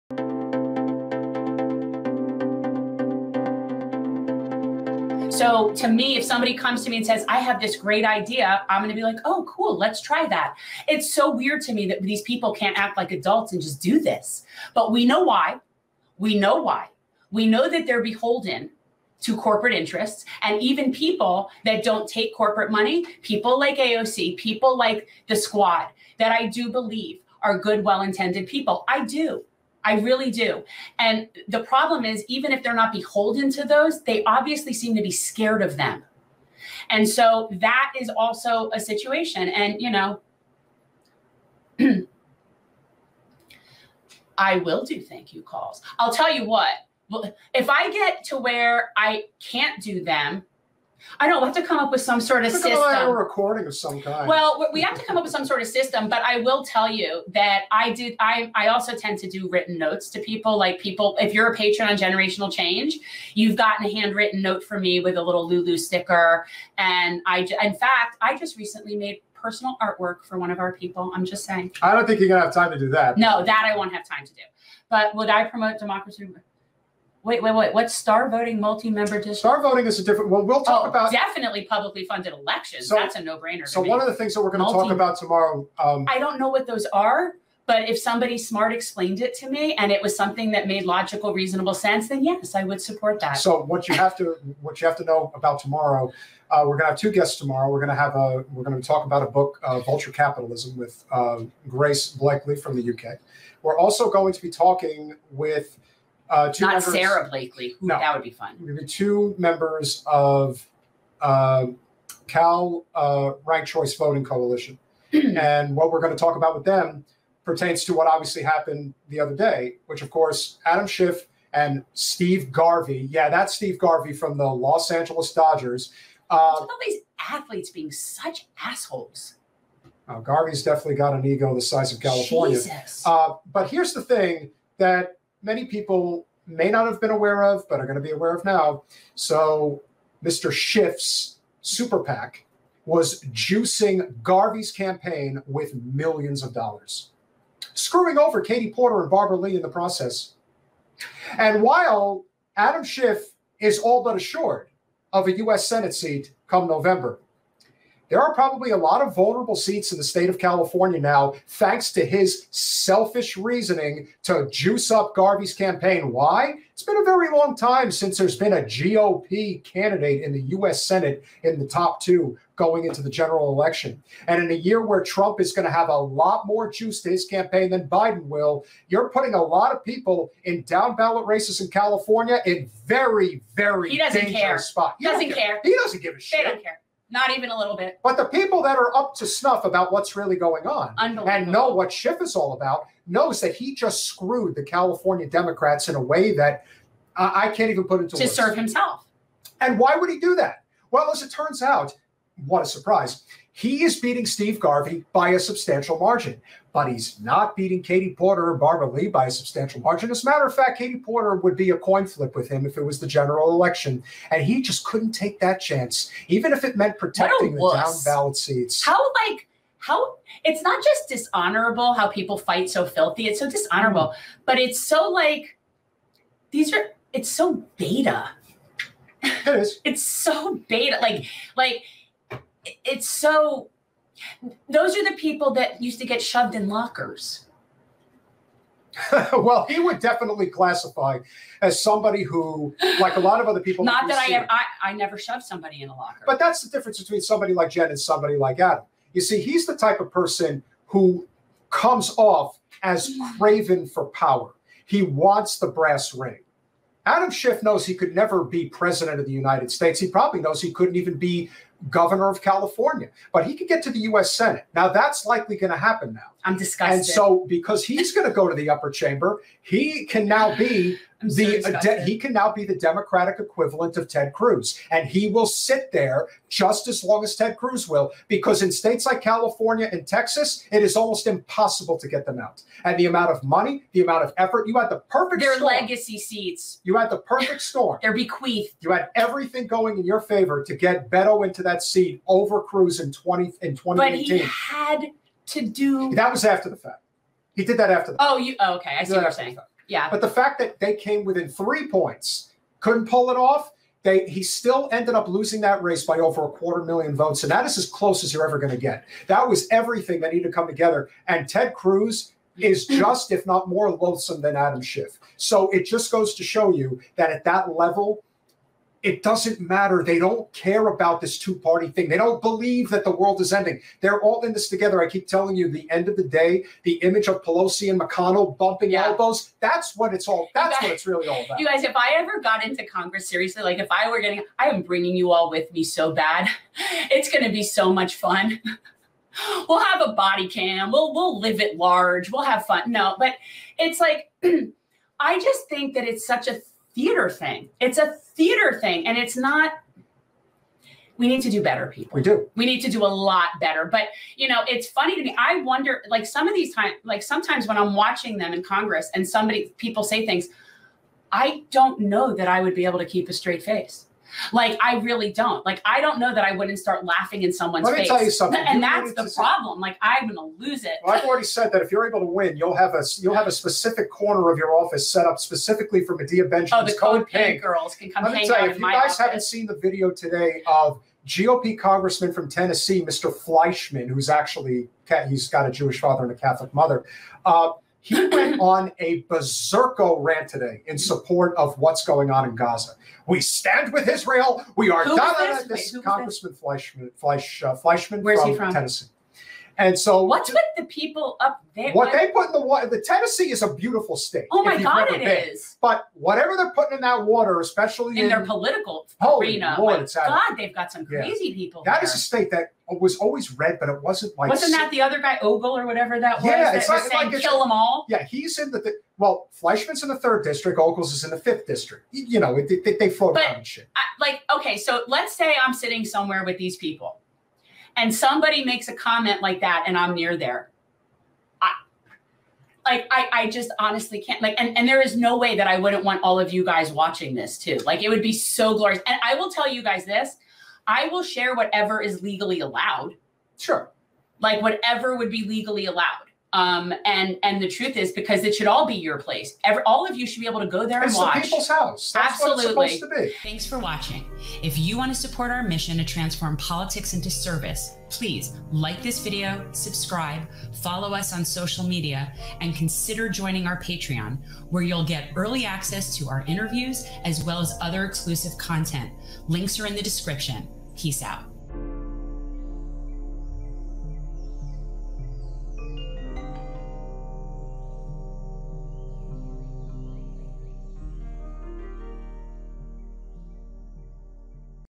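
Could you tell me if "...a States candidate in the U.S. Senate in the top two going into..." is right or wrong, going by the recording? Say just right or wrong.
wrong.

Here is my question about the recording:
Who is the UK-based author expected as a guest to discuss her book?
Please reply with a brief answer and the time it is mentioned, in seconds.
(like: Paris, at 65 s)
Grace Blakeley, at 101 s.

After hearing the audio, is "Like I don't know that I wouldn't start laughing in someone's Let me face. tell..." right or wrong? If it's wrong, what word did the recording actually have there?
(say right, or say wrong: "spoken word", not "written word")
right.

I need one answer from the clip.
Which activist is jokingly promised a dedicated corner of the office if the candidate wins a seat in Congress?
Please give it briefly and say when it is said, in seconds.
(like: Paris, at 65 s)
Medea Benjamin, at 376 s.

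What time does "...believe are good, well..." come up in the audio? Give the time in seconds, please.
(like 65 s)
26 s.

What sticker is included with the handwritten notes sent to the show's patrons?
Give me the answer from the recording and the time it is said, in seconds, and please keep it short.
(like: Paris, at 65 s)
Lulu sticker, at 65 s.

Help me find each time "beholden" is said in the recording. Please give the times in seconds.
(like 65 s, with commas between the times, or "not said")
18 s, 32 s.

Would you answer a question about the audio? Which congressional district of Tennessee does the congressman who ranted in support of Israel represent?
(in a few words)
Third district.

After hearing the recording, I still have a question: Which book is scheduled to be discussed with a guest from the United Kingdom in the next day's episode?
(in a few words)
Vulture Capitalism.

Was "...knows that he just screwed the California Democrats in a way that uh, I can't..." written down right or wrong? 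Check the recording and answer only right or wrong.
right.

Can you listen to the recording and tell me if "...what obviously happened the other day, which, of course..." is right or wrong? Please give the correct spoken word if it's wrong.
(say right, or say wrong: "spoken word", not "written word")
right.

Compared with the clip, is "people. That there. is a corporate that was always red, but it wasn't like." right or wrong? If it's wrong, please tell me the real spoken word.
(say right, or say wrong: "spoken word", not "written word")
wrong: "state", not "corporate".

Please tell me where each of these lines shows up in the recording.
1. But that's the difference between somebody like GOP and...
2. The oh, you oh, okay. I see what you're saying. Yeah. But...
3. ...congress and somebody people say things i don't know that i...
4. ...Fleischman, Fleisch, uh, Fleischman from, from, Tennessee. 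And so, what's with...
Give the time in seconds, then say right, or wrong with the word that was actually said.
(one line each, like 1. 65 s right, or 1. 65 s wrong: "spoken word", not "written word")
1. 246 s wrong: "Jen", not "GOP"
2. 298 s right
3. 358 s right
4. 396 s right.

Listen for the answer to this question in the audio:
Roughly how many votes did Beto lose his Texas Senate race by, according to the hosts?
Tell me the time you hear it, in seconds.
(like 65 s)
306 s.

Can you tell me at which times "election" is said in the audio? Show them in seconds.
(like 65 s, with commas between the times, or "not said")
82 s, 173 s, 213 s.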